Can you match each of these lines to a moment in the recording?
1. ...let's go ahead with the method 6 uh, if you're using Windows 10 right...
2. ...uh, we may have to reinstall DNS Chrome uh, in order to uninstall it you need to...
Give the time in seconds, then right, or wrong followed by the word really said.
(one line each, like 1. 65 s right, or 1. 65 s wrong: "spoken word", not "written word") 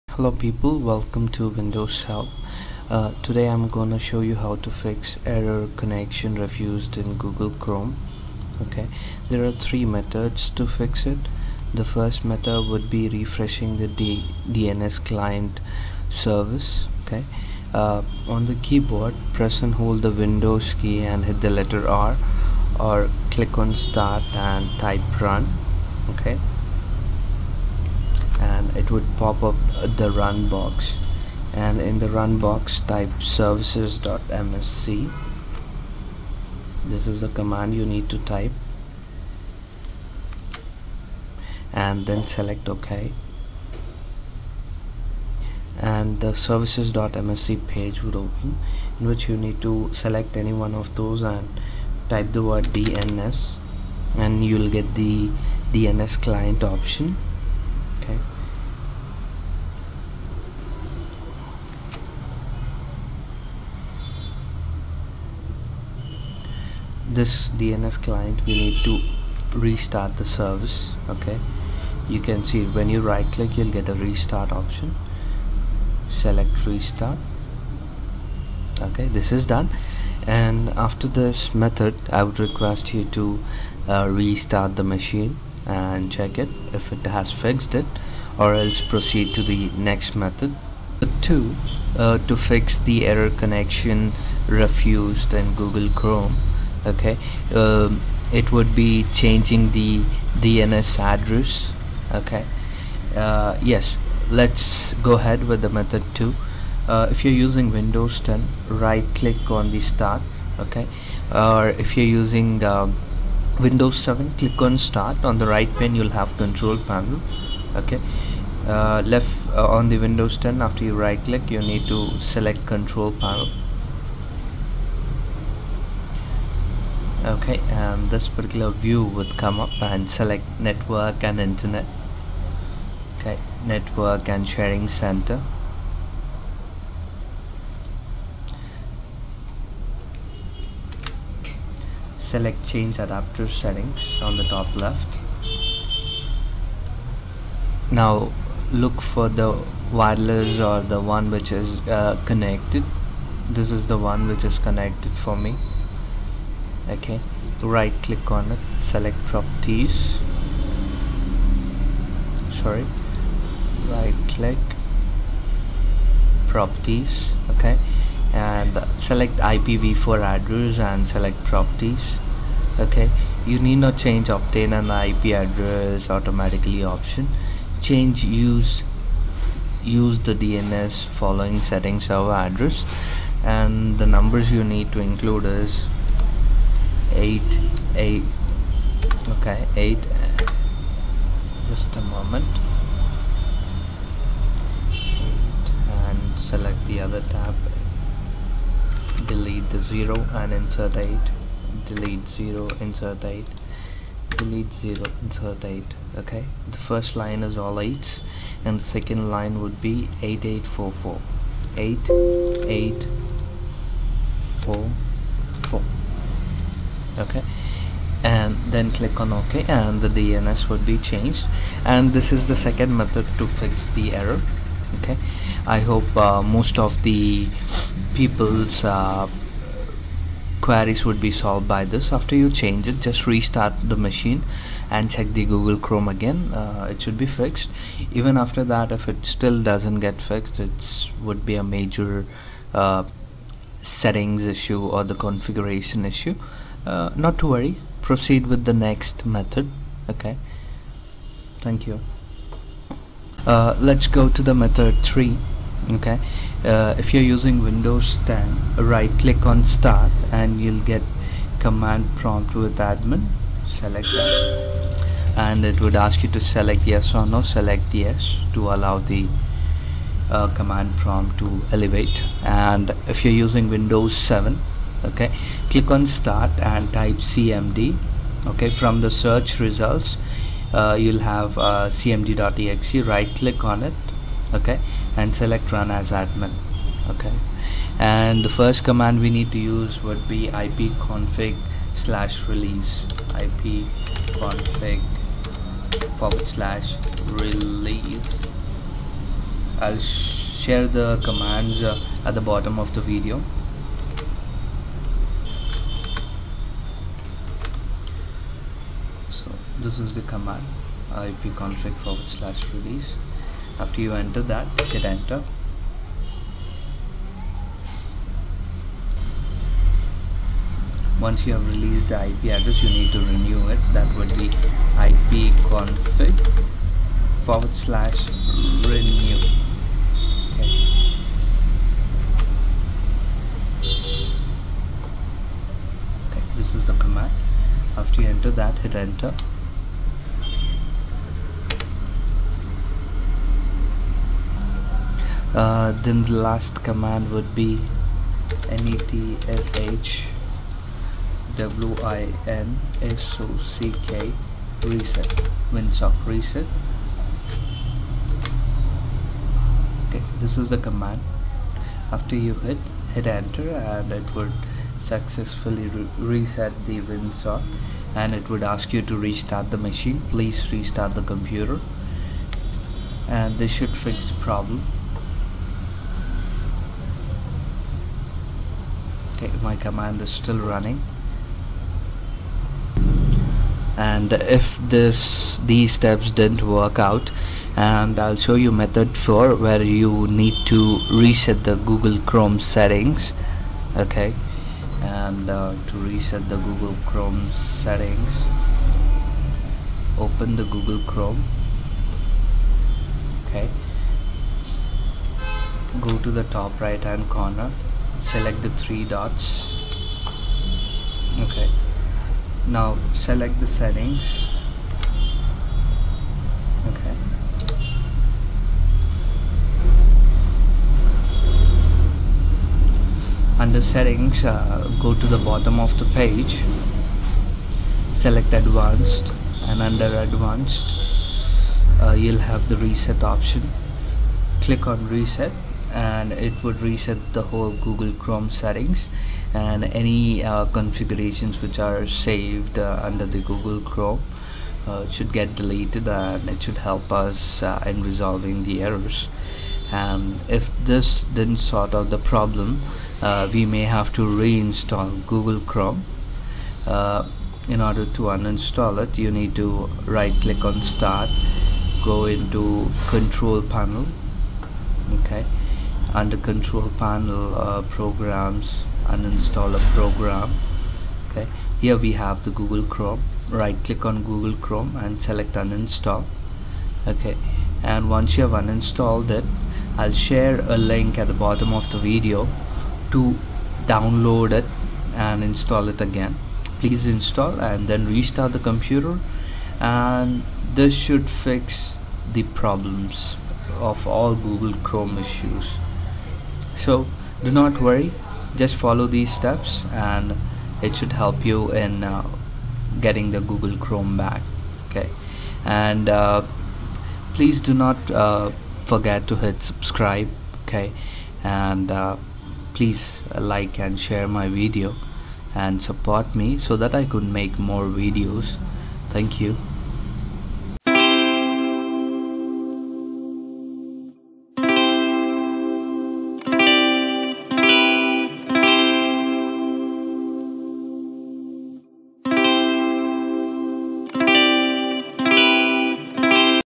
1. 104 s wrong: "2", not "6"
2. 453 s wrong: "Google", not "DNS".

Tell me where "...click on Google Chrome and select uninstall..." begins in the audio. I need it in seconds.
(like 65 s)
473 s.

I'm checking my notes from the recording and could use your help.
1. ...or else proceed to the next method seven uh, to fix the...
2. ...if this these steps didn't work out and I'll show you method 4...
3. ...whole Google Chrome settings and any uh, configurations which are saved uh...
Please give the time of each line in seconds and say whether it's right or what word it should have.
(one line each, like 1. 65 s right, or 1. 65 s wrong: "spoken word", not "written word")
1. 88 s wrong: "two", not "seven"
2. 384 s right
3. 437 s right.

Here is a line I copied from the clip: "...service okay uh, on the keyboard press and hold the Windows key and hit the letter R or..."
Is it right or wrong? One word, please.
right.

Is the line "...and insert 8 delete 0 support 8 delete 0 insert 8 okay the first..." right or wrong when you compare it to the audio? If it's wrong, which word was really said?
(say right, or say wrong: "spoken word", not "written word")
wrong: "insert", not "support".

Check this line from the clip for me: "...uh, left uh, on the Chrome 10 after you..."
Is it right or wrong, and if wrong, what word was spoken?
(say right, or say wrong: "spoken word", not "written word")
wrong: "Windows", not "Chrome".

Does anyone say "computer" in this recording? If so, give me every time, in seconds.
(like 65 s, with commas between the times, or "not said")
371 s, 488 s.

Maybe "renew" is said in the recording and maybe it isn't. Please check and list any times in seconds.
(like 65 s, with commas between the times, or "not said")
323 s, 328 s.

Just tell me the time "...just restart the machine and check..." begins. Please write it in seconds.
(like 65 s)
233 s.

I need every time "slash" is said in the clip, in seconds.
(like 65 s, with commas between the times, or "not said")
291 s, 296 s, 312 s, 327 s.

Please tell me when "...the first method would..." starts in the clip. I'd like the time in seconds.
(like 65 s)
11 s.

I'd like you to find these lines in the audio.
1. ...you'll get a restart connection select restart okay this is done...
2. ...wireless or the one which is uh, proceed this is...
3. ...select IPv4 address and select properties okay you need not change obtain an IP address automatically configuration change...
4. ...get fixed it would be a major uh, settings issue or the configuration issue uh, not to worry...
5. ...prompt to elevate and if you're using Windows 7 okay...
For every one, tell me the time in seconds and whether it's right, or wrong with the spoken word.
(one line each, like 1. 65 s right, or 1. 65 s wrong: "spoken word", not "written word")
1. 73 s wrong: "option", not "connection"
2. 149 s wrong: "connected", not "proceed"
3. 168 s wrong: "option", not "configuration"
4. 240 s right
5. 270 s right.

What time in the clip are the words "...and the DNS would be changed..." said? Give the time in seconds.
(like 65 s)
219 s.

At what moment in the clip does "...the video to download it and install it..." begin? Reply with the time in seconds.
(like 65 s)
481 s.